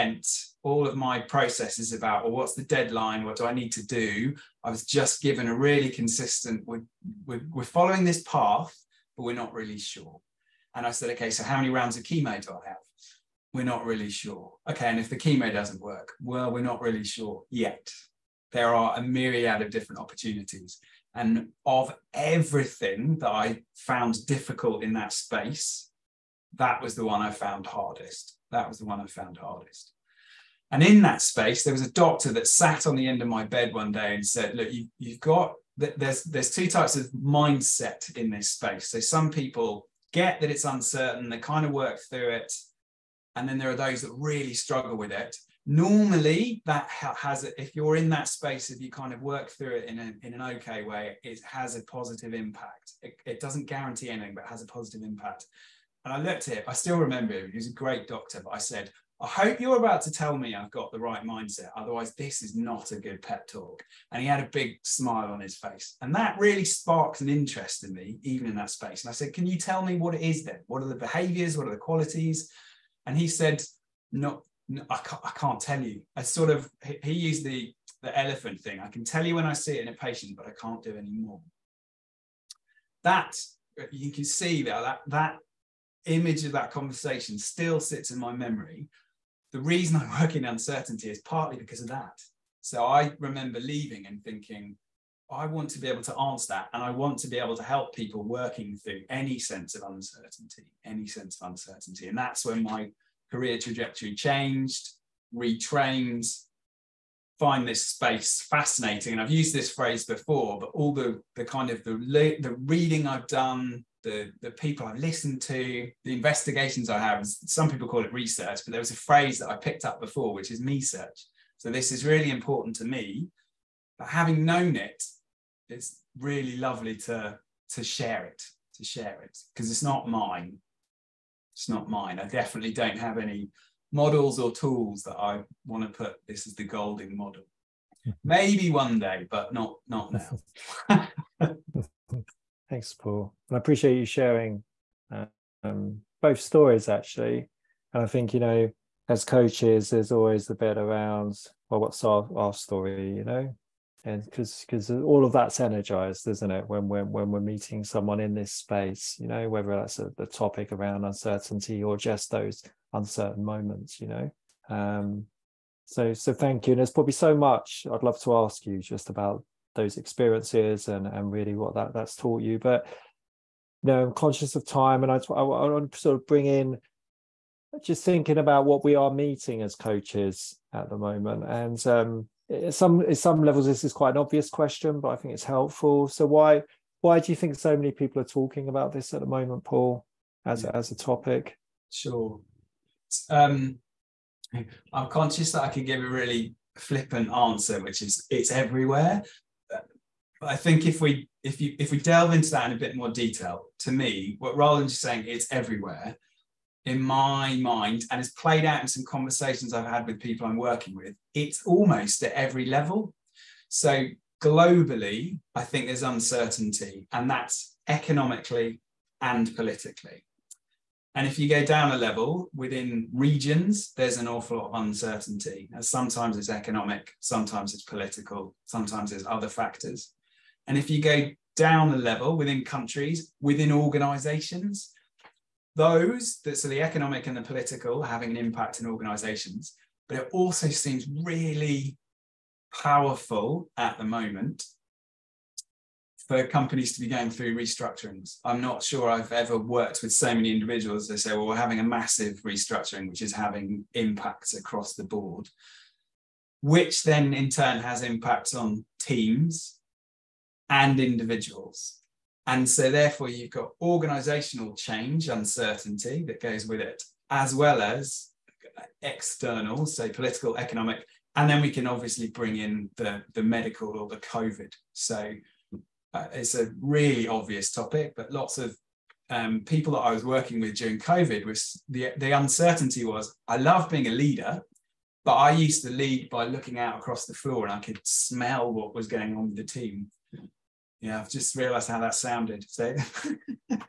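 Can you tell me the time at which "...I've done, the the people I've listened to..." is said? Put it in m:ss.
1:53.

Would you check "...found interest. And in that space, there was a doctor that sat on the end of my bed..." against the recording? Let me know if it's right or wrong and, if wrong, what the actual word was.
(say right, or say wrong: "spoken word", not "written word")
wrong: "hardest", not "interest".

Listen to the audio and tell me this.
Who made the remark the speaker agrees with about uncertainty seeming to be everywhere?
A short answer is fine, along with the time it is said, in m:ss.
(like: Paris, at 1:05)
Roland, at 3:24.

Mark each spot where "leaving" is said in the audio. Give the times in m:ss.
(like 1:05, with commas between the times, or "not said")
1:33.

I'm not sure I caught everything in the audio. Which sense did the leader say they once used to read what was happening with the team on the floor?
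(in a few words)
smell.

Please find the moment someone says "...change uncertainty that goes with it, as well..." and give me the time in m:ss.
4:24.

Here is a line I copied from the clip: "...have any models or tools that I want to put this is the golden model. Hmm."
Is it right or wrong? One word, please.
right.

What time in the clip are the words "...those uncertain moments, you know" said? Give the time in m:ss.
2:42.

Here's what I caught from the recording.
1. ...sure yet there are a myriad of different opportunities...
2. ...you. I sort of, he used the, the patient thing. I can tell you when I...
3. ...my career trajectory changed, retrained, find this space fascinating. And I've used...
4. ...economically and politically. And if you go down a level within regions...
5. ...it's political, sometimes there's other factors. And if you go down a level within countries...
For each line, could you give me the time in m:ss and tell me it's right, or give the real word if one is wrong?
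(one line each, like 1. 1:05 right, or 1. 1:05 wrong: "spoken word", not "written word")
1. 0:17 right
2. 1:15 wrong: "elephant", not "patient"
3. 1:42 right
4. 3:37 right
5. 3:47 right.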